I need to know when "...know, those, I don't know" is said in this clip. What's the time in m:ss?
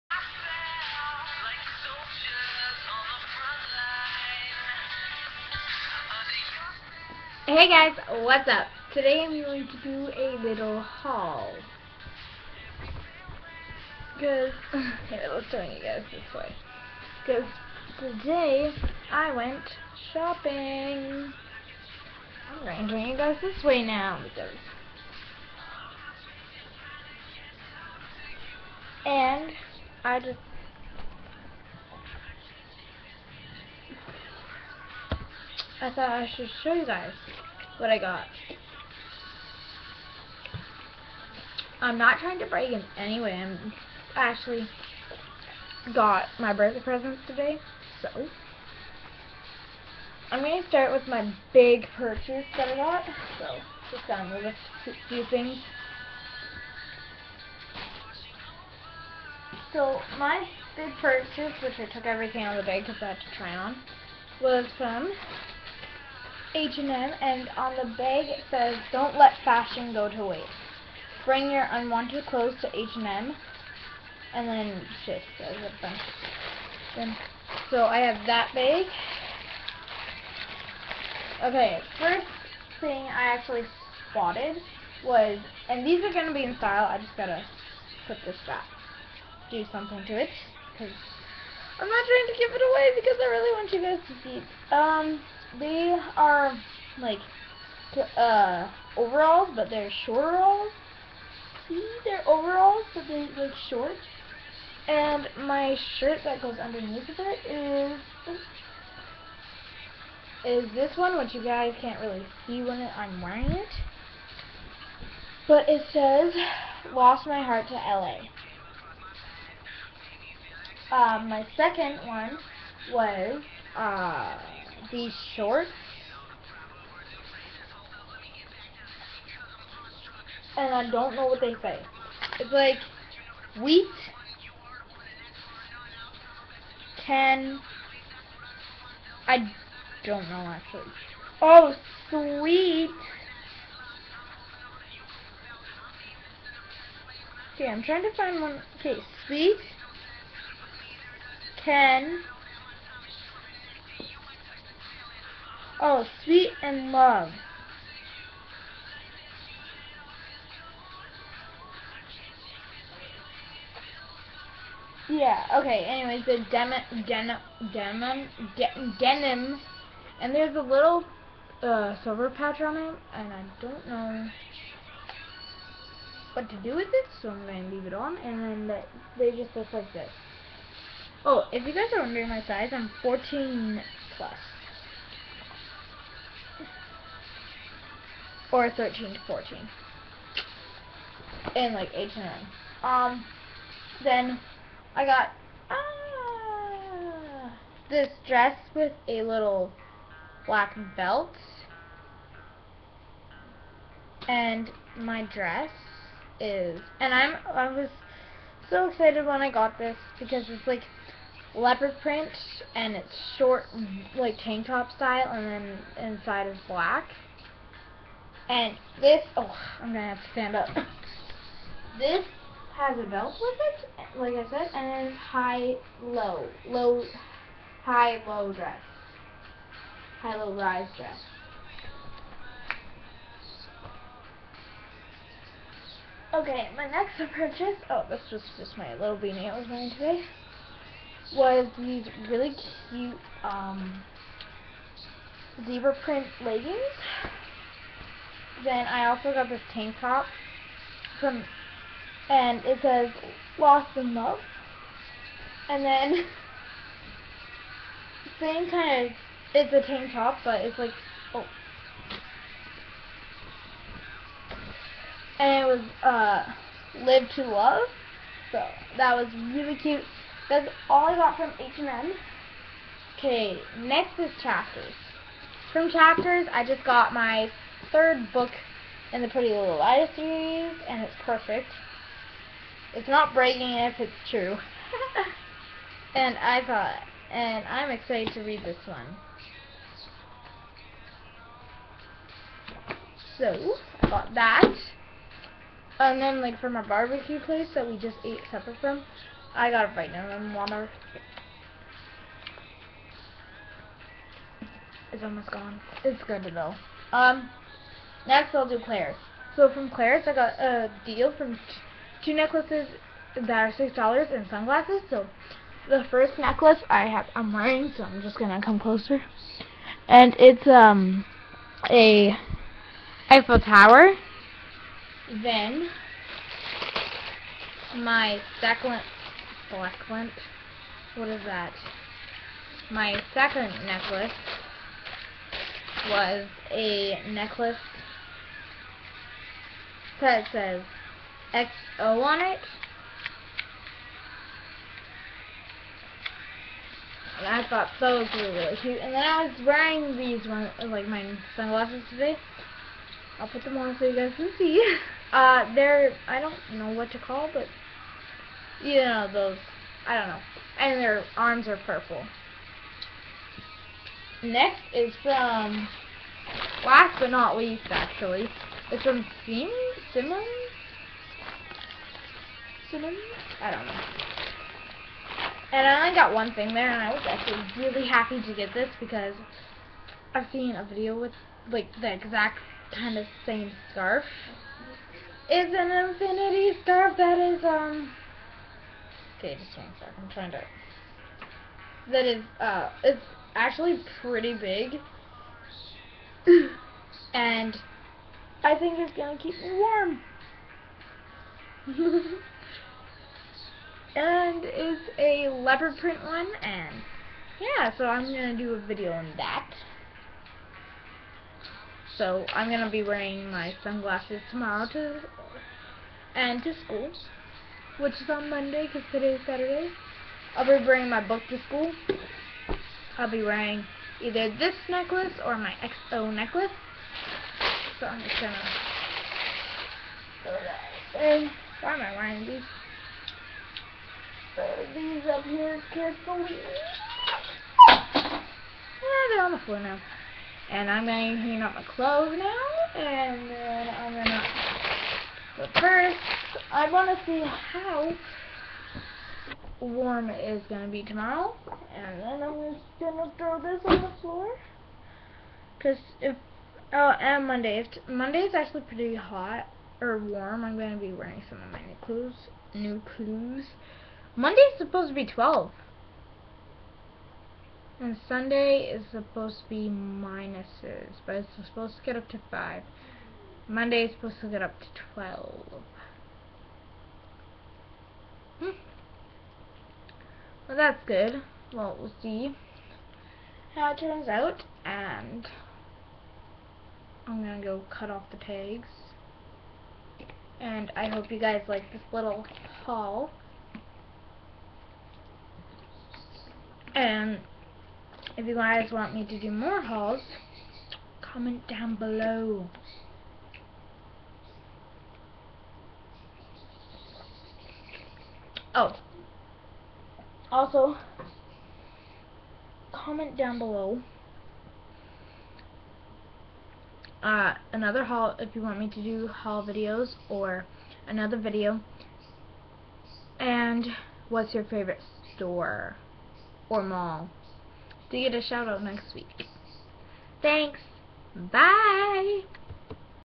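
5:59.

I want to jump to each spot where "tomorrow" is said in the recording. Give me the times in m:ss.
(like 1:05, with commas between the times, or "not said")
6:54, 7:31.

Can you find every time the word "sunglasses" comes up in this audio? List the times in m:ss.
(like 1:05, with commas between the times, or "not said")
5:14, 5:51, 6:53.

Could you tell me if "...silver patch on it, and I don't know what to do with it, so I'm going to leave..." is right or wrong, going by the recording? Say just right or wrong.
right.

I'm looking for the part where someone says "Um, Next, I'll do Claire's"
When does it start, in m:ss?
5:07.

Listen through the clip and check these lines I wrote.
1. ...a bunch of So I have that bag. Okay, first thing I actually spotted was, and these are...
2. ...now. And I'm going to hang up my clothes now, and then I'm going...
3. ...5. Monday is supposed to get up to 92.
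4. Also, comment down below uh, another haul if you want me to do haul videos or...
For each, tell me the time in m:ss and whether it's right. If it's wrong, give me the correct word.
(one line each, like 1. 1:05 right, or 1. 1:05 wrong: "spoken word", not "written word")
1. 1:15 right
2. 7:19 right
3. 7:52 wrong: "12", not "92"
4. 8:30 right.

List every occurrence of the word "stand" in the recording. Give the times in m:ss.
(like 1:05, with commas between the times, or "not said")
3:40.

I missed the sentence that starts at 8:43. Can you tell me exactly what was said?
And what's your favorite store or mall?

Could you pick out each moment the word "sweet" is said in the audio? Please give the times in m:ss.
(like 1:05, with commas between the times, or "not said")
2:22, 2:29, 2:36.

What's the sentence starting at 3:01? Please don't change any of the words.
Oh, if you guys are wondering my size, I'm 14 plus.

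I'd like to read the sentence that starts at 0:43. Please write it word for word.
I'm actually got my birthday presents today, so I'm going to start with my big purchase that I got.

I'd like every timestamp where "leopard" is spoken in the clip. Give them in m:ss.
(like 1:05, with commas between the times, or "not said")
3:31, 6:45.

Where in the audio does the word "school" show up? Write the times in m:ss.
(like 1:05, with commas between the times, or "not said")
6:56, 7:01.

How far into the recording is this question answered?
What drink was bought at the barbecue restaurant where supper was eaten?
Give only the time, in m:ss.
4:59.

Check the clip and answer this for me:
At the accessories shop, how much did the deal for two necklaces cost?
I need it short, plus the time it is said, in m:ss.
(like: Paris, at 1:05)
$6, at 5:13.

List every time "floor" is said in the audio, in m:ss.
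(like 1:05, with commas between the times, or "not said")
7:19, 7:34.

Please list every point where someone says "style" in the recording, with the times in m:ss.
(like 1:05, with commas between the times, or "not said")
1:26, 3:34.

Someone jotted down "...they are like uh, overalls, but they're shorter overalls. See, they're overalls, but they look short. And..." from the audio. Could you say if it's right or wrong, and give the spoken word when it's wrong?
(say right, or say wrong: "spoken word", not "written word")
right.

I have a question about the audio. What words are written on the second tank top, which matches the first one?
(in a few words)
Live to Love.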